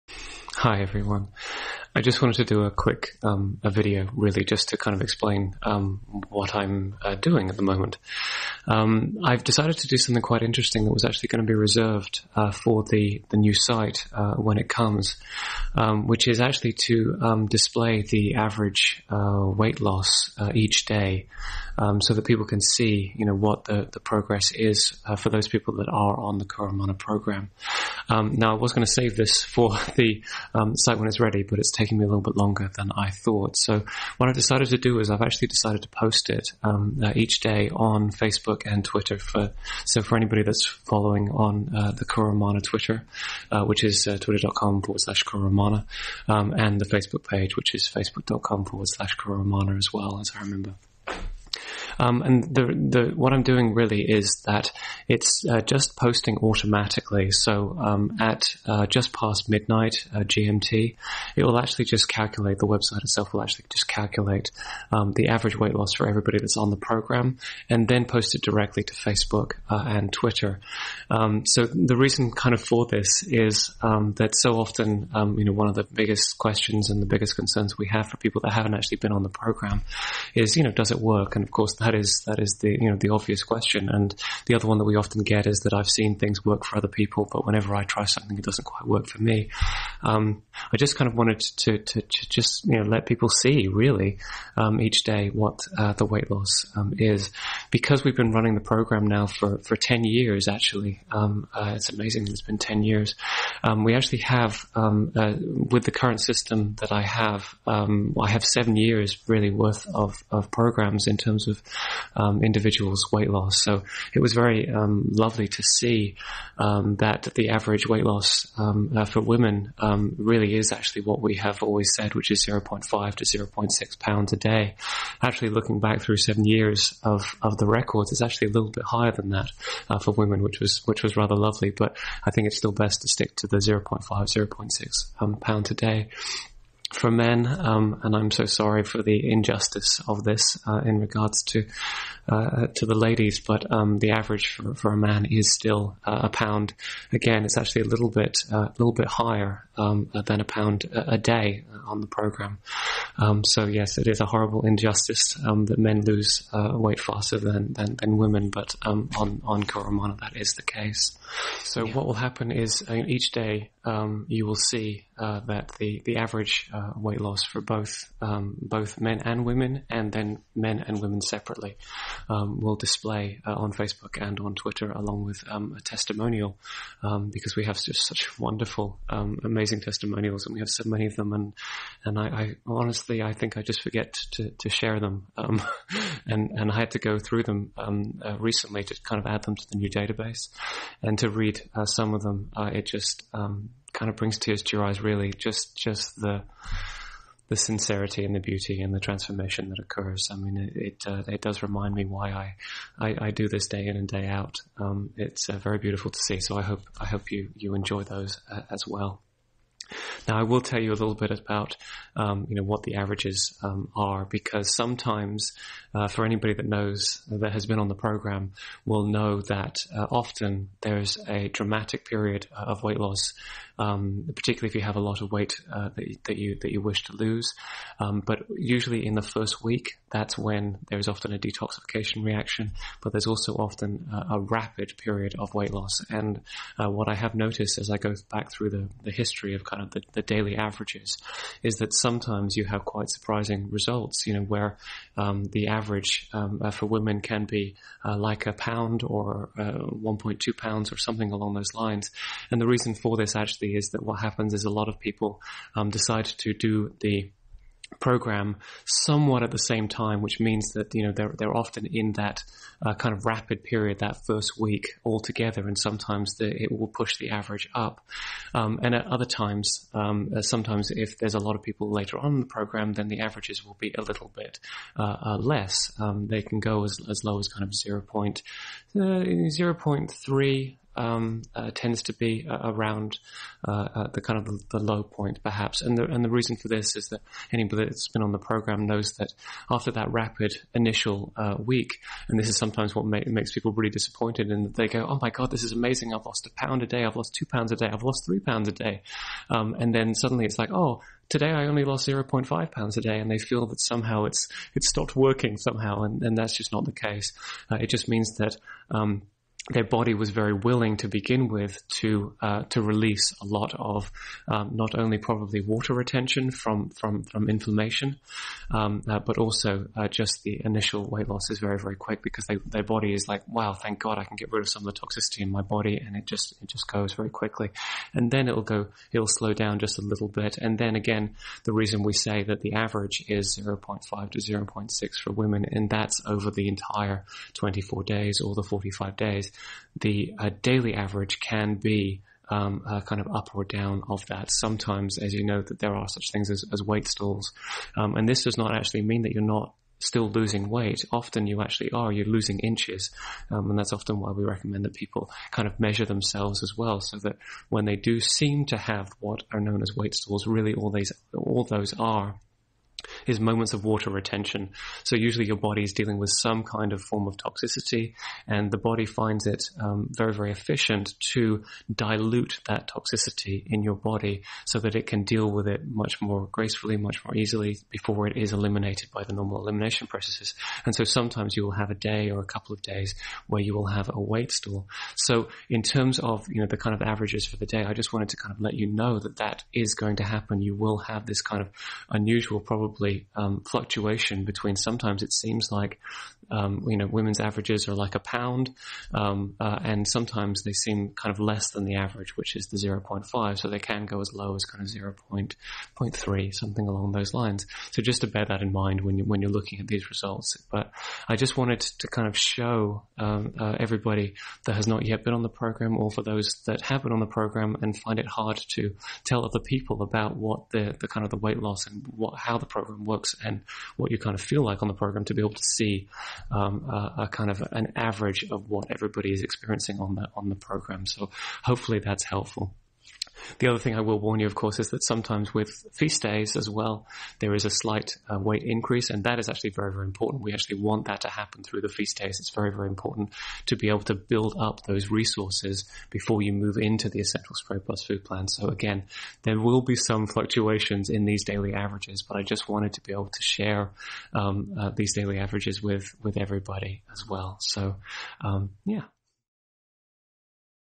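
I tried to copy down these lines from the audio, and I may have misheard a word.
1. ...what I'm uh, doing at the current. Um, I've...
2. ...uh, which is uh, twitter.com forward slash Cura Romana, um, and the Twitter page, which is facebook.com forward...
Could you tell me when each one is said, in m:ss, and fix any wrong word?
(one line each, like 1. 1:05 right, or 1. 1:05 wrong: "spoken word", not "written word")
1. 0:06 wrong: "moment", not "current"
2. 0:43 wrong: "Facebook", not "Twitter".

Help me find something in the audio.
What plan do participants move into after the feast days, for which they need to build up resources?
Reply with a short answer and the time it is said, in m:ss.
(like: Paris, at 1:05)
essential spray plus food plan, at 7:27.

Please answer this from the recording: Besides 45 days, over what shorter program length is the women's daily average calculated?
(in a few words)
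24 days.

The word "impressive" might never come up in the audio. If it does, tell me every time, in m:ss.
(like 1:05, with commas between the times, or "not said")
not said.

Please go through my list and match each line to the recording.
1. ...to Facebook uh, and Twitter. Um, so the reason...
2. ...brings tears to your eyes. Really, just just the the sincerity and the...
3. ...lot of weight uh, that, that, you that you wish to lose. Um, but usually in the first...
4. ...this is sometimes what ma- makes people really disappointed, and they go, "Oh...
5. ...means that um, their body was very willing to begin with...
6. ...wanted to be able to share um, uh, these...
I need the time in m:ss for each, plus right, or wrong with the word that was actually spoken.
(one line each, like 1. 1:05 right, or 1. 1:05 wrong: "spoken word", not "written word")
1. 1:08 right
2. 3:14 right
3. 3:45 right
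4. 4:52 right
5. 5:08 right
6. 7:32 right.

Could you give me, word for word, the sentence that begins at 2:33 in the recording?
Um, so yes, it is a horrible injustice um, that men lose weight faster than than, than women.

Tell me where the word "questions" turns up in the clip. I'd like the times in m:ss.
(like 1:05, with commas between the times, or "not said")
1:16, 1:23.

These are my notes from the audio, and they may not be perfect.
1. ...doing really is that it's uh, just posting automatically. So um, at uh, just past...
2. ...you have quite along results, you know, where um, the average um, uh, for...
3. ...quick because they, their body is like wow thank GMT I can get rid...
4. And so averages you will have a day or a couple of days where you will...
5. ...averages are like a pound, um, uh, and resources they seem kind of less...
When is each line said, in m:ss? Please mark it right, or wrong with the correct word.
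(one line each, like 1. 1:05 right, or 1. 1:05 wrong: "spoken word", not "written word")
1. 0:53 right
2. 4:02 wrong: "surprising", not "along"
3. 5:21 wrong: "God", not "GMT"
4. 6:20 wrong: "sometimes", not "averages"
5. 6:37 wrong: "sometimes", not "resources".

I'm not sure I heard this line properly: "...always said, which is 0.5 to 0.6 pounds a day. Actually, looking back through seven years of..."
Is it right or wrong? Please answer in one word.
right.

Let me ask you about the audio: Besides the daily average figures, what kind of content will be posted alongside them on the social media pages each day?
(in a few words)
a testimonial.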